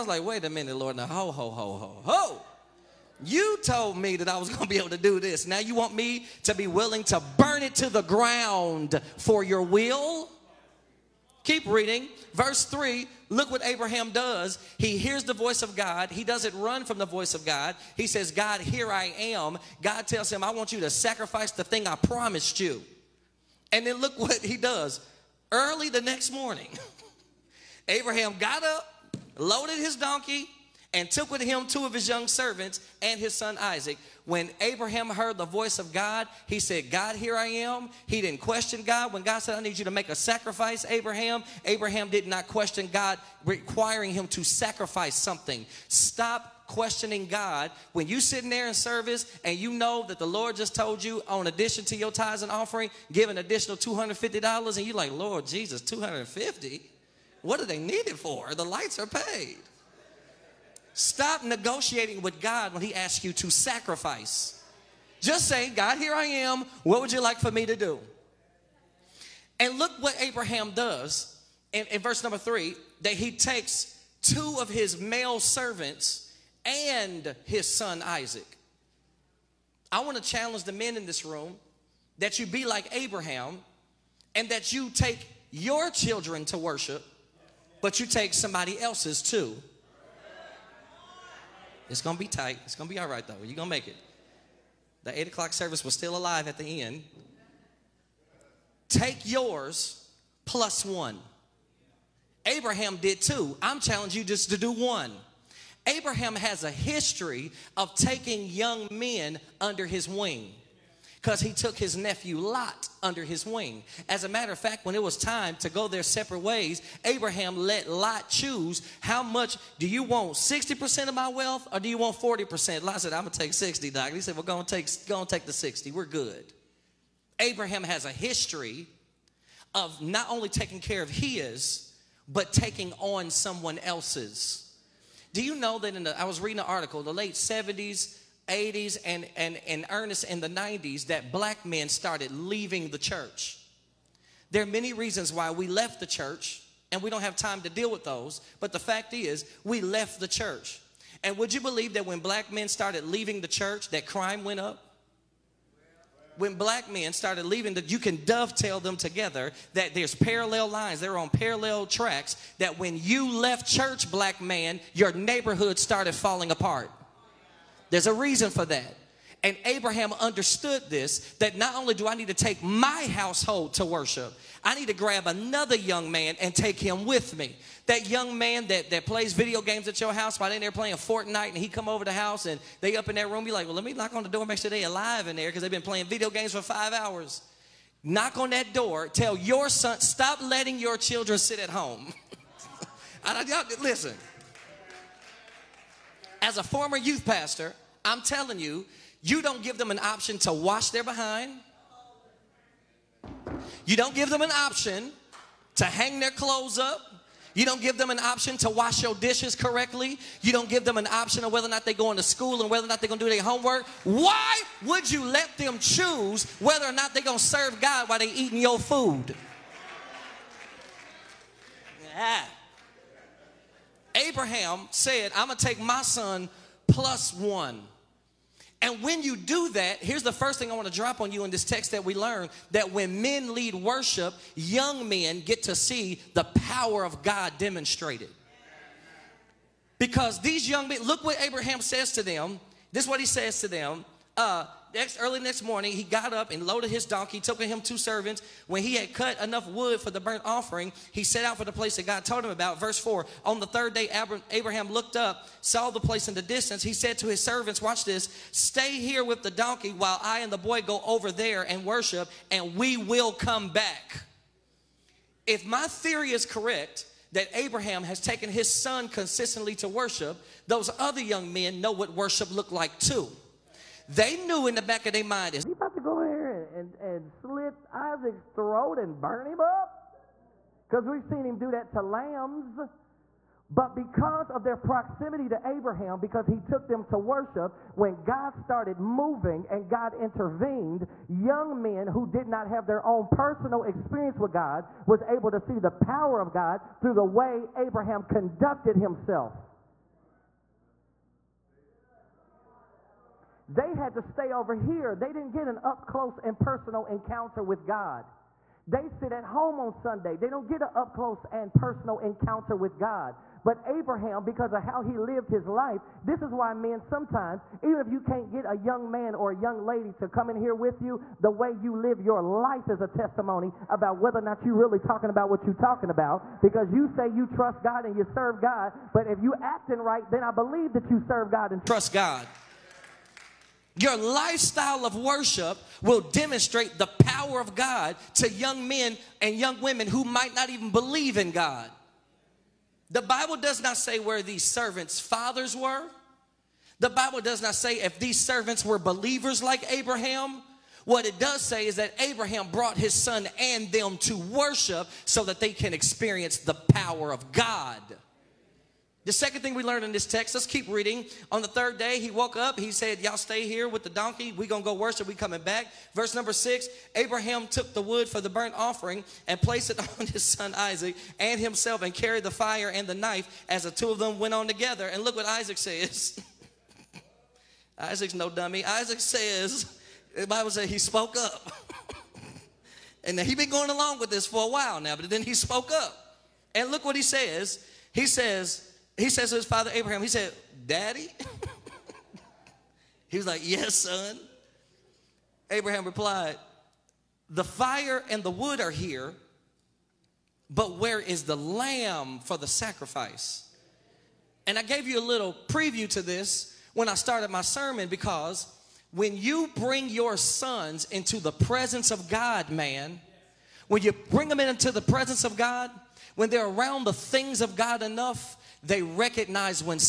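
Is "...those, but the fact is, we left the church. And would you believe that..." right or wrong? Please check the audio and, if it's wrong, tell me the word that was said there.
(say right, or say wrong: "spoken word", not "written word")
right.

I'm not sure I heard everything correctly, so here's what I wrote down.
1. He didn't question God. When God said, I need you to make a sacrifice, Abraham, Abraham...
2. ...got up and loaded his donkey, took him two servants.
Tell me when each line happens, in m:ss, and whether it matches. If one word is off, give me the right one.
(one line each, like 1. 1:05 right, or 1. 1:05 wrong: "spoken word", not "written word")
1. 0:38 right
2. 4:06 right.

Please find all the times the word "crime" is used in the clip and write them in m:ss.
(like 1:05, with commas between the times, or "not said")
2:34.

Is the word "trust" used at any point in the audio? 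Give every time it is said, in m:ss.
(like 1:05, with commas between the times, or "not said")
5:27, 5:31.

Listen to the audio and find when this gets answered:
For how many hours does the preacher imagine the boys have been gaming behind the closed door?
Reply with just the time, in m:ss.
3:06.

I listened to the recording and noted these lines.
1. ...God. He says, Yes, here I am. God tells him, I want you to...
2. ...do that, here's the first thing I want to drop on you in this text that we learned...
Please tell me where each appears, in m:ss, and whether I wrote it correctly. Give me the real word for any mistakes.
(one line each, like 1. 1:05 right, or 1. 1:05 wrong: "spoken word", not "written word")
1. 0:17 wrong: "God", not "Yes"
2. 3:49 right.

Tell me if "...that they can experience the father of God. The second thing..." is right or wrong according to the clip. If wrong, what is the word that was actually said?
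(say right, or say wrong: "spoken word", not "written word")
wrong: "power", not "father".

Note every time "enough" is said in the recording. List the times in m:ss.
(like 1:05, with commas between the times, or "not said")
4:09, 6:58.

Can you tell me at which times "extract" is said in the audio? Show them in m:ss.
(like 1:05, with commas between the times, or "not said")
not said.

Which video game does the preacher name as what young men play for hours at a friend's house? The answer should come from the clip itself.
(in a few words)
Fortnite.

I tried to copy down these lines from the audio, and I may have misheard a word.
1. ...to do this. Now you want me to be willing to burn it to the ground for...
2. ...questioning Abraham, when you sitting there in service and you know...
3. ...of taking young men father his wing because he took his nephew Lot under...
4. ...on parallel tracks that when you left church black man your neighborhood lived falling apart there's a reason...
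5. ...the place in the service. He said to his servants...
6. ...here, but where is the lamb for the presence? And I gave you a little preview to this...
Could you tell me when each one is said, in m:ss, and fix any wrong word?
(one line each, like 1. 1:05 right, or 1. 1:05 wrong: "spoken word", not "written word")
1. 0:04 right
2. 0:46 wrong: "God", not "Abraham"
3. 1:47 wrong: "under", not "father"
4. 2:41 wrong: "started", not "lived"
5. 4:15 wrong: "distance", not "service"
6. 6:38 wrong: "sacrifice", not "presence".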